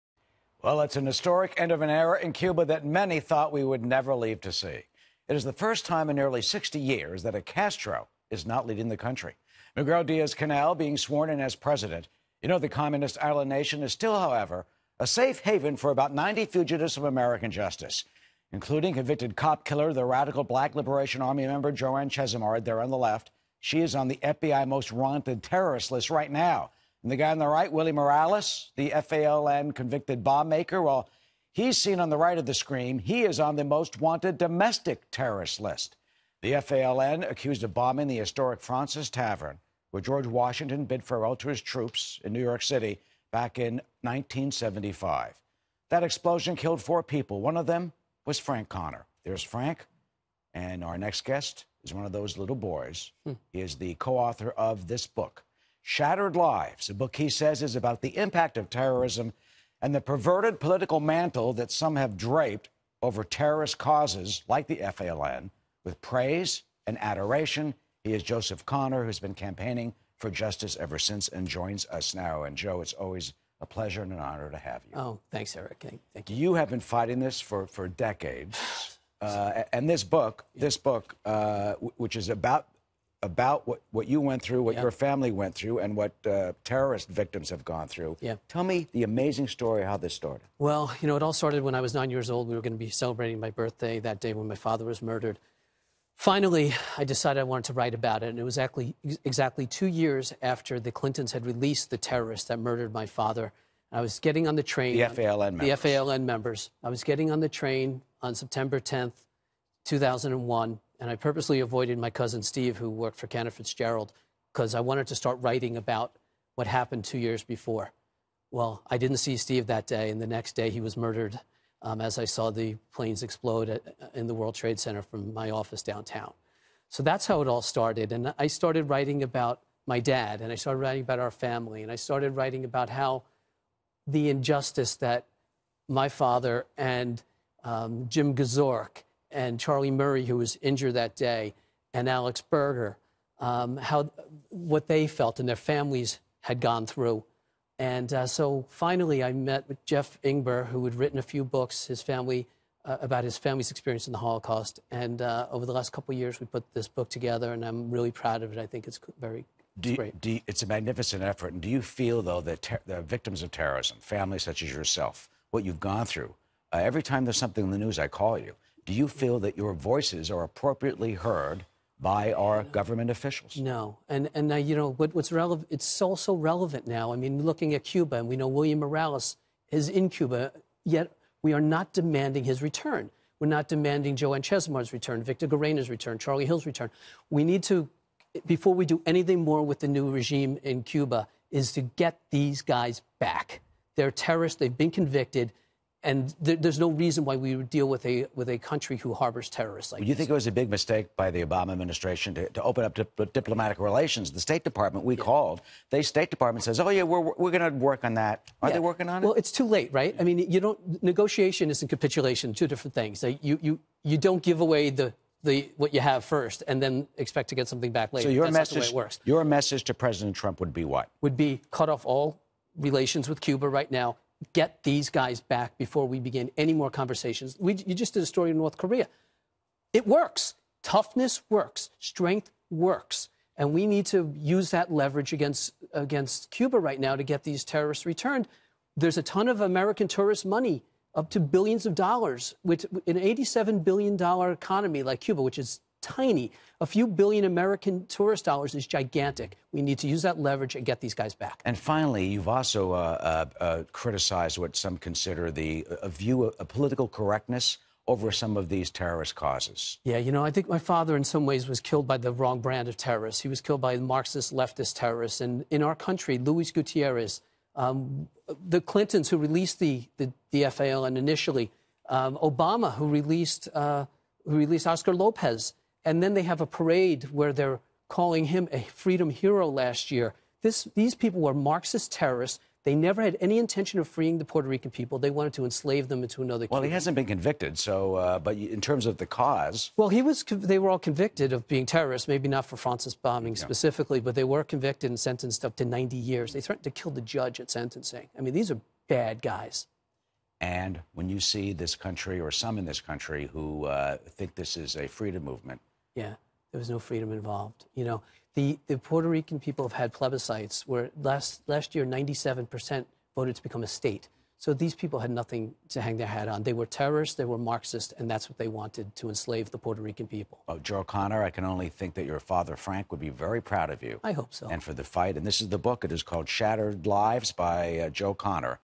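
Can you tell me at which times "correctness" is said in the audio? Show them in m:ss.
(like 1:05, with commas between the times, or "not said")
4:17.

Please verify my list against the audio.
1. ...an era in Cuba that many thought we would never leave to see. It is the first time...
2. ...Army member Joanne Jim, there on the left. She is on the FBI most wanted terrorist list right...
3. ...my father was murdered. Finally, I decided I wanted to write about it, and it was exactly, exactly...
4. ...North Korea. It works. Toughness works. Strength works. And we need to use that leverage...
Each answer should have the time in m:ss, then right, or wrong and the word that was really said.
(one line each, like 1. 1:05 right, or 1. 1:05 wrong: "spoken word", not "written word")
1. 0:01 right
2. 0:21 wrong: "Chesimard", not "Jim"
3. 1:34 right
4. 3:48 right.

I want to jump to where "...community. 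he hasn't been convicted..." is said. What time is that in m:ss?
4:46.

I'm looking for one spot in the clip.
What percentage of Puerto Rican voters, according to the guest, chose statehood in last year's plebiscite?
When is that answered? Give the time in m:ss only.
5:12.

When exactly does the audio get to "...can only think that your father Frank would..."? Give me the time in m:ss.
5:21.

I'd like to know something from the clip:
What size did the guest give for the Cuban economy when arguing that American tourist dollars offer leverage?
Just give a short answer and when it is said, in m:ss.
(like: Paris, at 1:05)
$87 billion, at 4:03.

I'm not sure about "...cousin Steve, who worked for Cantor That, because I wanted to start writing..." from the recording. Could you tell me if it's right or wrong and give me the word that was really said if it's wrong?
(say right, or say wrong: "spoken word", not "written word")
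wrong: "Fitzgerald", not "That".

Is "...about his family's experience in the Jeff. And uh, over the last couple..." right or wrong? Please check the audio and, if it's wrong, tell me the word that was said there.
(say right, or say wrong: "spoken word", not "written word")
wrong: "Holocaust", not "Jeff".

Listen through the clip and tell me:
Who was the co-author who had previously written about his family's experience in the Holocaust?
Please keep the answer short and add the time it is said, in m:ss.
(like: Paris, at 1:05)
Jeff Ingber, at 2:29.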